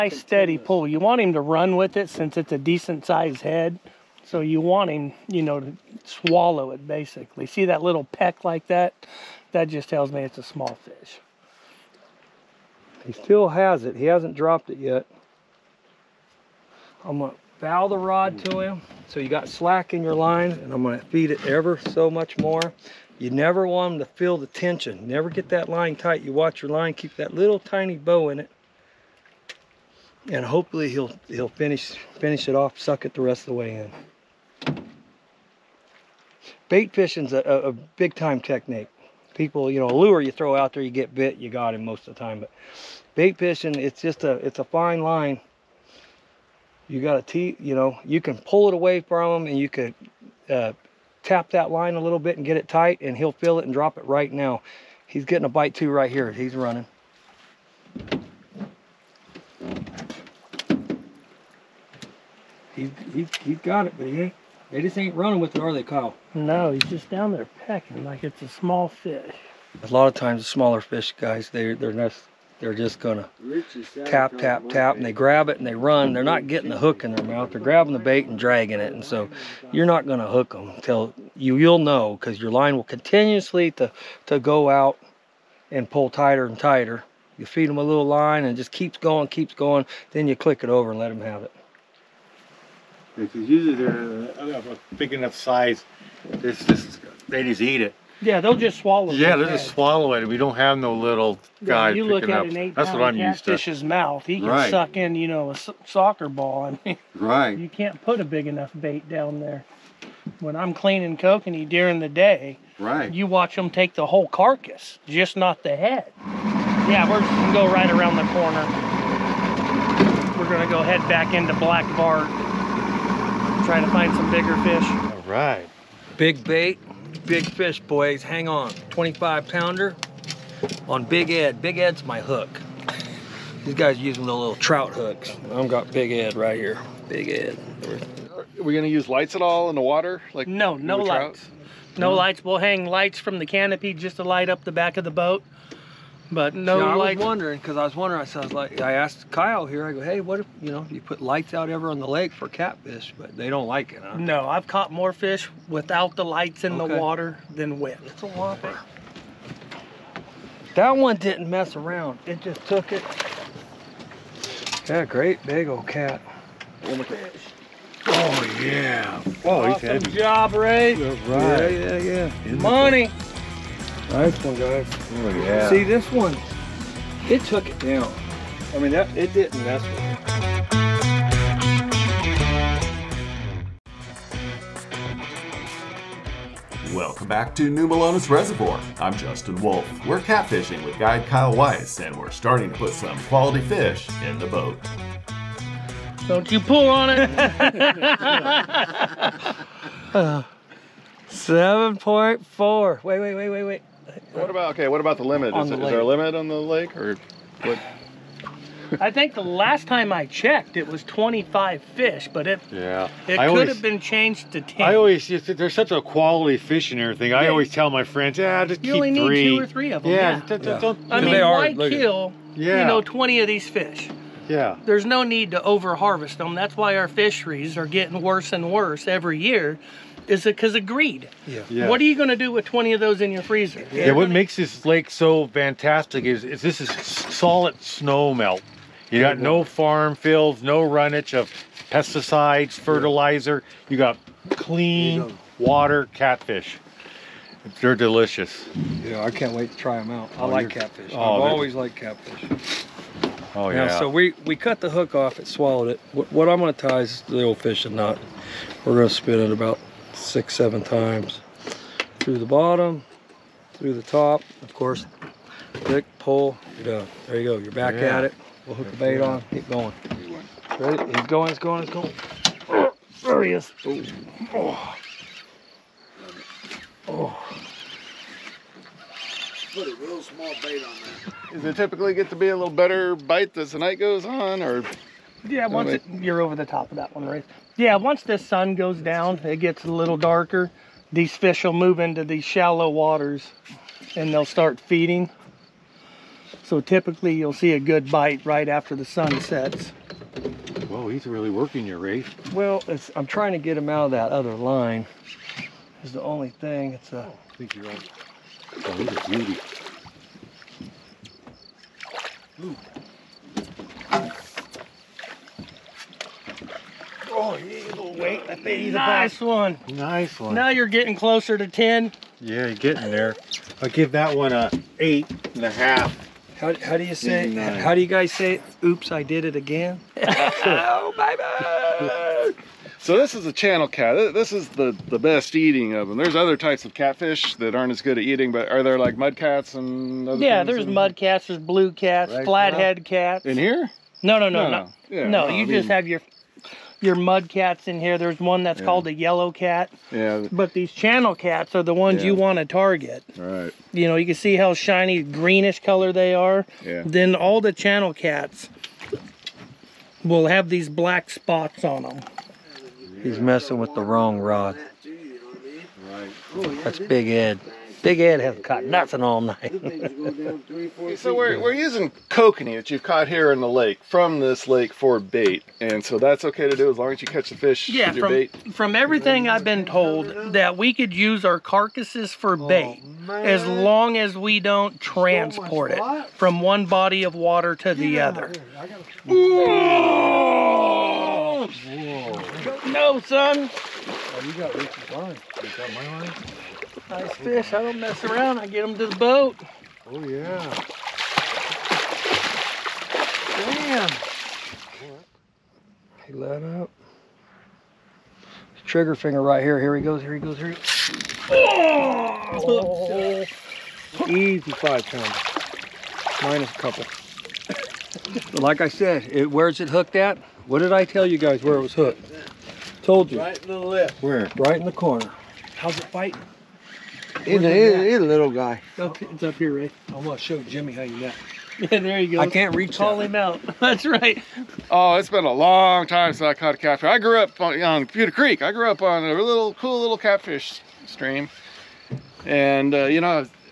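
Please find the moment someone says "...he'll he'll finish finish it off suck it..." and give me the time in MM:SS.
00:30.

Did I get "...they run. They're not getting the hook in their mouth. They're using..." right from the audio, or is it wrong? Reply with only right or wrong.
wrong.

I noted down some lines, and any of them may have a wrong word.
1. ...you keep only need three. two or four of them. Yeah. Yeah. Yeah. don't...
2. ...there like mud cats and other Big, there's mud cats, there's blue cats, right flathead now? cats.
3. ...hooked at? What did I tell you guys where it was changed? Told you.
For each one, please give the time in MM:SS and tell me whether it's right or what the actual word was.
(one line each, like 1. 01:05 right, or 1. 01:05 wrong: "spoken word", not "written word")
1. 03:38 wrong: "three", not "four"
2. 05:38 wrong: "Yeah", not "Big"
3. 06:59 wrong: "hooked", not "changed".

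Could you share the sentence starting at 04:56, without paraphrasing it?
So typically you'll see a good bite right after the sun sets.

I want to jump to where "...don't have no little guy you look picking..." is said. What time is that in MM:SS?
01:40.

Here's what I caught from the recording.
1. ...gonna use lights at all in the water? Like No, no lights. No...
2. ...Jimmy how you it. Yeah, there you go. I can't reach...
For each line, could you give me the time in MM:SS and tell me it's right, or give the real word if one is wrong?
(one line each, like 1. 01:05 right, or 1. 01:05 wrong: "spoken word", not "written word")
1. 02:18 right
2. 07:10 right.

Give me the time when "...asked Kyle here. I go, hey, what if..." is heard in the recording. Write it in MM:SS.
02:28.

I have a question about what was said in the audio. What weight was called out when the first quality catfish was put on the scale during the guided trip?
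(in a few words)
7.4.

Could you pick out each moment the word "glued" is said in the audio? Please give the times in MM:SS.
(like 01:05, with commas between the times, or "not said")
not said.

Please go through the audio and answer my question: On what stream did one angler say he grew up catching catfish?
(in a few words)
Putah Creek.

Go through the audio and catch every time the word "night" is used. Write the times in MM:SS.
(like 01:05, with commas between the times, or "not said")
04:43, 06:09.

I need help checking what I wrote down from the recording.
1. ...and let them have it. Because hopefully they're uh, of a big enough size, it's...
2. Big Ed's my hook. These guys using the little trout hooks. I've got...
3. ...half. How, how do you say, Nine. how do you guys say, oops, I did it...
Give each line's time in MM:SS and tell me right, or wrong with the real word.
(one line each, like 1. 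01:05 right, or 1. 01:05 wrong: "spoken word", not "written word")
1. 01:30 wrong: "usually", not "hopefully"
2. 02:11 right
3. 05:25 right.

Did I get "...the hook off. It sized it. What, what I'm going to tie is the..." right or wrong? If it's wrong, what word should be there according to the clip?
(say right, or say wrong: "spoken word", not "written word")
wrong: "swallowed", not "sized".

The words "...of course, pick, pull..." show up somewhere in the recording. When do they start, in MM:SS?
04:24.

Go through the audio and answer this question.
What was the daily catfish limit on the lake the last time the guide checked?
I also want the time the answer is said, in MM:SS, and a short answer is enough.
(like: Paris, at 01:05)
25 fish, at 03:31.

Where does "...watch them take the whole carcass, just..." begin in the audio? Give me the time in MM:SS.
01:53.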